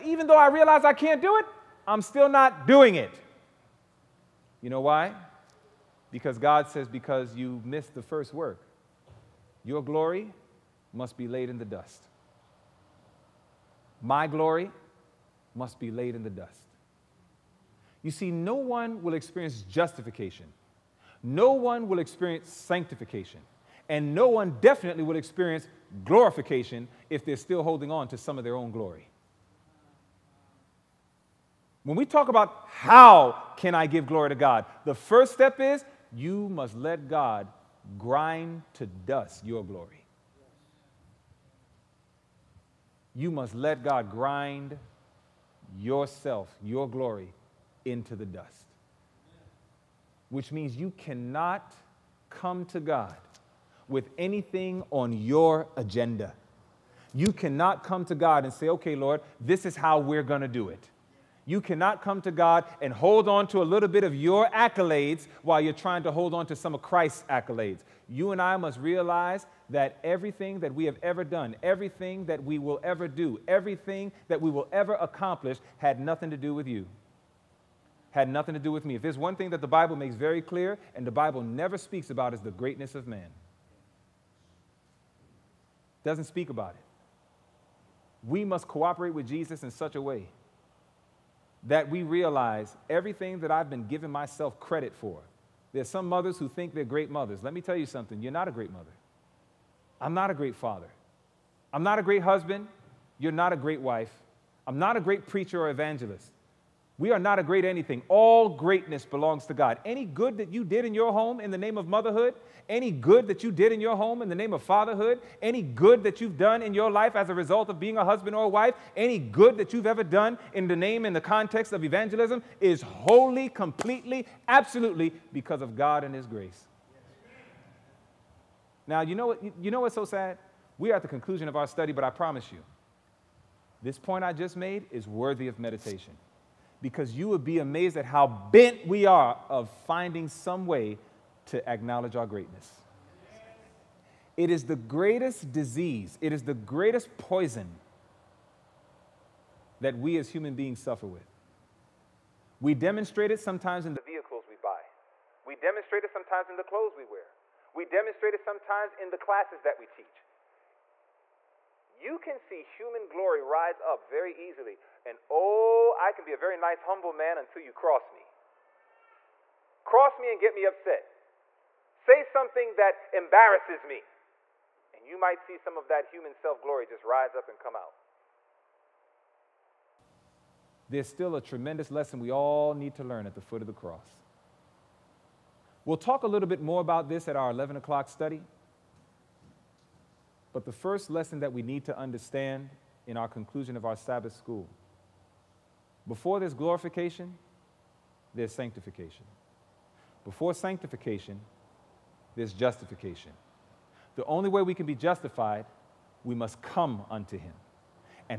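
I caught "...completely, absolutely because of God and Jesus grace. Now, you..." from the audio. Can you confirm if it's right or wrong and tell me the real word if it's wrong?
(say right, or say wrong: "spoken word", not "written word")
wrong: "His", not "Jesus".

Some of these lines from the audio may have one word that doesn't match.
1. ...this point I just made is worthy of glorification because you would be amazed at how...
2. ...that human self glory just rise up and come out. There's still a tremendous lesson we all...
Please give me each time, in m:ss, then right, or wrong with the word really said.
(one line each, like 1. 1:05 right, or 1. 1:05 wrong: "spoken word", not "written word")
1. 2:13 wrong: "meditation", not "glorification"
2. 2:55 right.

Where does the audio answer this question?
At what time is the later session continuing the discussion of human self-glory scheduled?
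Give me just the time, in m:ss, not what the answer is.
3:07.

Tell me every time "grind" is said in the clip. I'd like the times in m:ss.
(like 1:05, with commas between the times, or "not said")
0:37, 0:44.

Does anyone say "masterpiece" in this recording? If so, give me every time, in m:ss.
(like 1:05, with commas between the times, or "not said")
not said.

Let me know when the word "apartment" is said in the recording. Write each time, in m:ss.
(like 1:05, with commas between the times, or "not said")
not said.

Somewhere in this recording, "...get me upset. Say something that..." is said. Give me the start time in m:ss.
2:50.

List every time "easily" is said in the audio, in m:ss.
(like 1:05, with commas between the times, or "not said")
2:44.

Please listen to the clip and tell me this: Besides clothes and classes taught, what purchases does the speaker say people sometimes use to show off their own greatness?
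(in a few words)
Vehicles.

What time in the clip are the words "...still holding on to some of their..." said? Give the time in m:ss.
0:27.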